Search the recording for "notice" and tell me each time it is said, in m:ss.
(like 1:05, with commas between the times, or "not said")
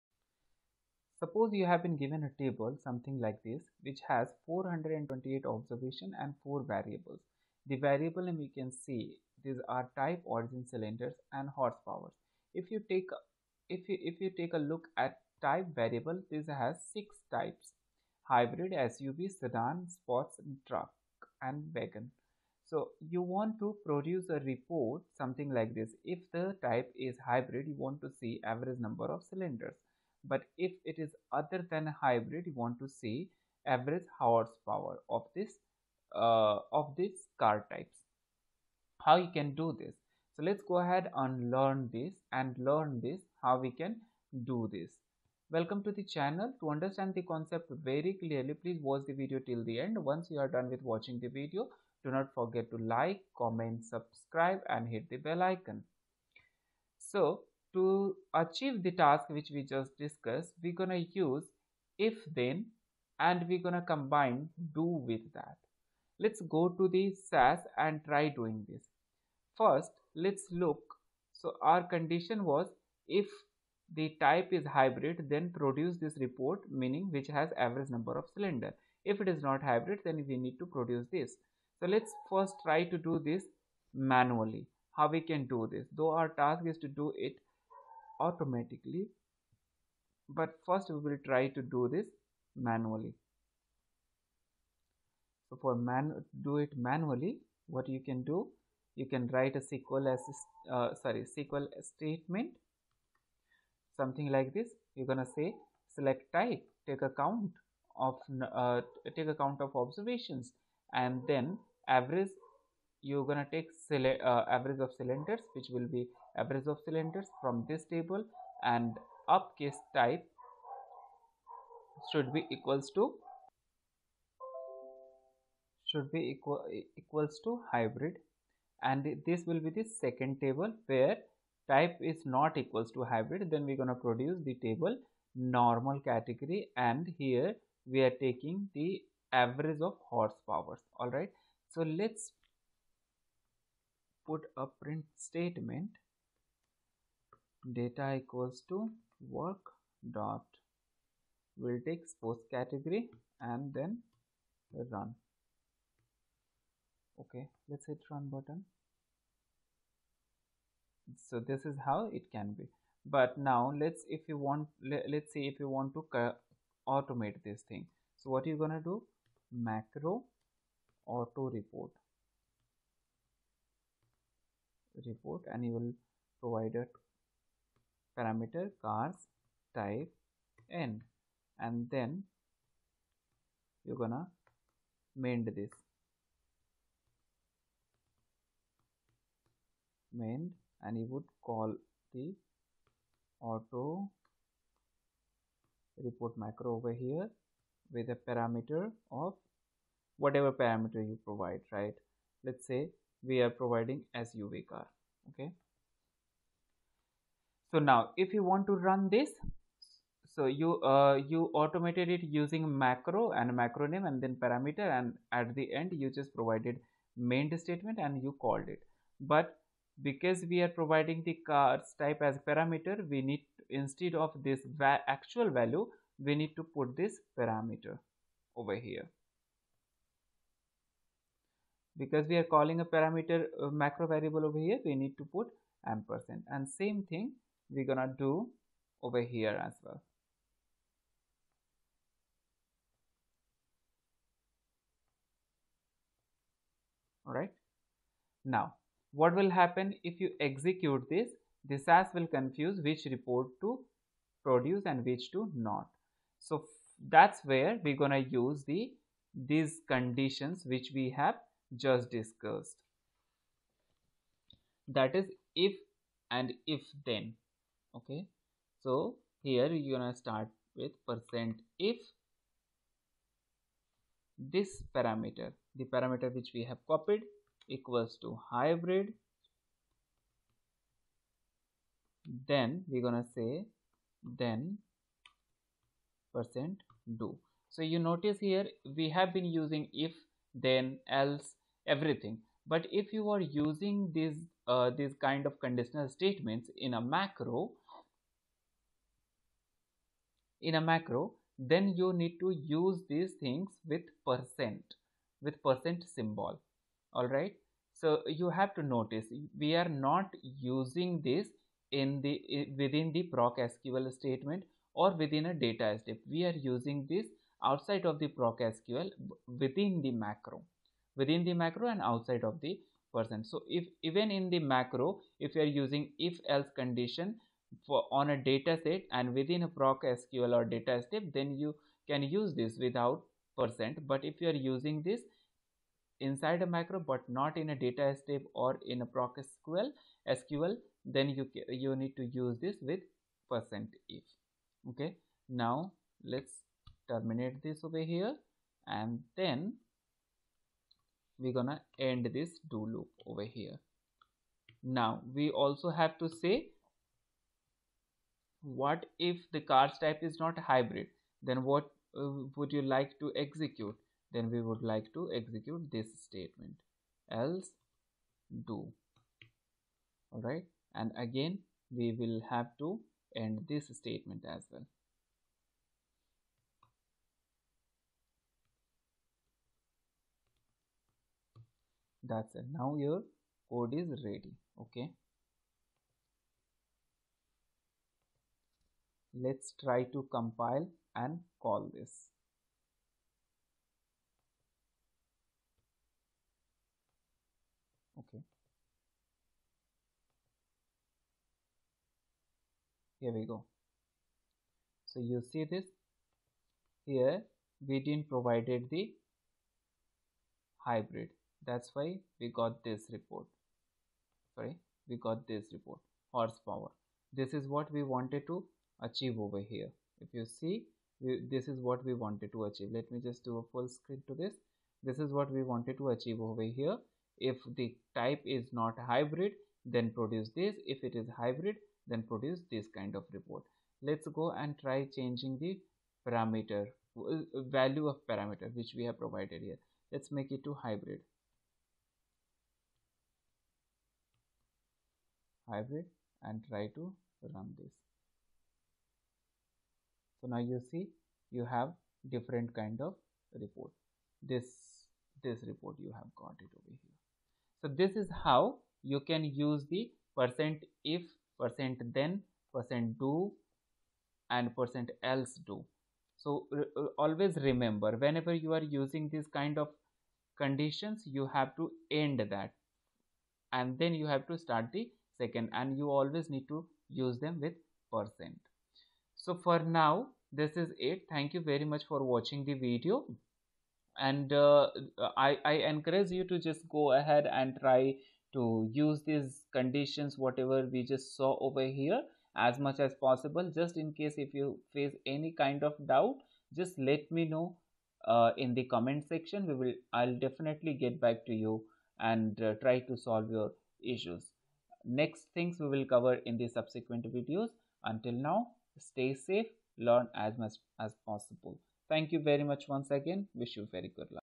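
4:47, 5:08.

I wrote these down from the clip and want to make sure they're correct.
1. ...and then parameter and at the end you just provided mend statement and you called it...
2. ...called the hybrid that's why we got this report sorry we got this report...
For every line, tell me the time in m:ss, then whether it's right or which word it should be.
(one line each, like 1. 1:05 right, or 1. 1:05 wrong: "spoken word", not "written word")
1. 3:34 right
2. 6:48 wrong: "provided", not "called".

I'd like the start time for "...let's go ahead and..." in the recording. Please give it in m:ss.
0:40.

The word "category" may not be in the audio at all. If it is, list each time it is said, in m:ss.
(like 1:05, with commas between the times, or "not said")
2:15, 2:32.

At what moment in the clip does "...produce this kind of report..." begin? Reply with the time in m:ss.
7:12.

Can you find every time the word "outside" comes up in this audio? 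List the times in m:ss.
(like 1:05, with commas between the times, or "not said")
5:17, 5:22.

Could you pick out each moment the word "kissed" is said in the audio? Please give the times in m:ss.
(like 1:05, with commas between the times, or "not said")
not said.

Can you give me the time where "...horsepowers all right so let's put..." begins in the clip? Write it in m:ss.
2:20.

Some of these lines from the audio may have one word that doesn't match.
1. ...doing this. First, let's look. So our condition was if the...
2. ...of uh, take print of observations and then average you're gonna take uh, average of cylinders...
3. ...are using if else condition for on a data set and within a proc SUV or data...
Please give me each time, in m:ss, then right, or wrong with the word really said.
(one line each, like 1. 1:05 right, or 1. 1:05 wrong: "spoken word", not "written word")
1. 1:08 right
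2. 1:48 wrong: "account", not "print"
3. 5:25 wrong: "SQL", not "SUV".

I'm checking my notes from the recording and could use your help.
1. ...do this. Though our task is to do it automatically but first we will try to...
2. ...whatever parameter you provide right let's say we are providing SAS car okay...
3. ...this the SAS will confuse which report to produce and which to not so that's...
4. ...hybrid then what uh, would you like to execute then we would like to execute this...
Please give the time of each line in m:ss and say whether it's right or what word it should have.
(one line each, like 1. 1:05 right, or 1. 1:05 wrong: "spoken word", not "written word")
1. 1:25 right
2. 3:20 wrong: "SUV", not "SAS"
3. 4:11 right
4. 6:00 right.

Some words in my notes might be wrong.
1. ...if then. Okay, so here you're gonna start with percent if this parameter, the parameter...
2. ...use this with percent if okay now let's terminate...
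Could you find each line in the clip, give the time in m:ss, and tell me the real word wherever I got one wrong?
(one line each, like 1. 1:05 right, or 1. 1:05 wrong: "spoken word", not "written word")
1. 4:26 right
2. 5:42 right.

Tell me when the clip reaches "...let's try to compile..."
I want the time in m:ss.
6:29.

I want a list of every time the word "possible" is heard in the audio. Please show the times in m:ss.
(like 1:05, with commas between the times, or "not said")
8:13, 8:31.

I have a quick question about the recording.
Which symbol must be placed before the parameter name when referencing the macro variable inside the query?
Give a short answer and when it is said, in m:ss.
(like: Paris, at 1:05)
ampersand, at 3:55.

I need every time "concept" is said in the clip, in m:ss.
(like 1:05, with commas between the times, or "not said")
0:47.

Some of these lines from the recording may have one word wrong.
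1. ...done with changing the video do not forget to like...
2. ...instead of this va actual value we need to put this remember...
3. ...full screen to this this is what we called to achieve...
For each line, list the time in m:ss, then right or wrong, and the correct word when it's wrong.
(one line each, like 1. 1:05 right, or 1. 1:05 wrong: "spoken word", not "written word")
1. 0:50 wrong: "watching", not "changing"
2. 3:43 wrong: "parameter", not "remember"
3. 7:03 wrong: "wanted", not "called".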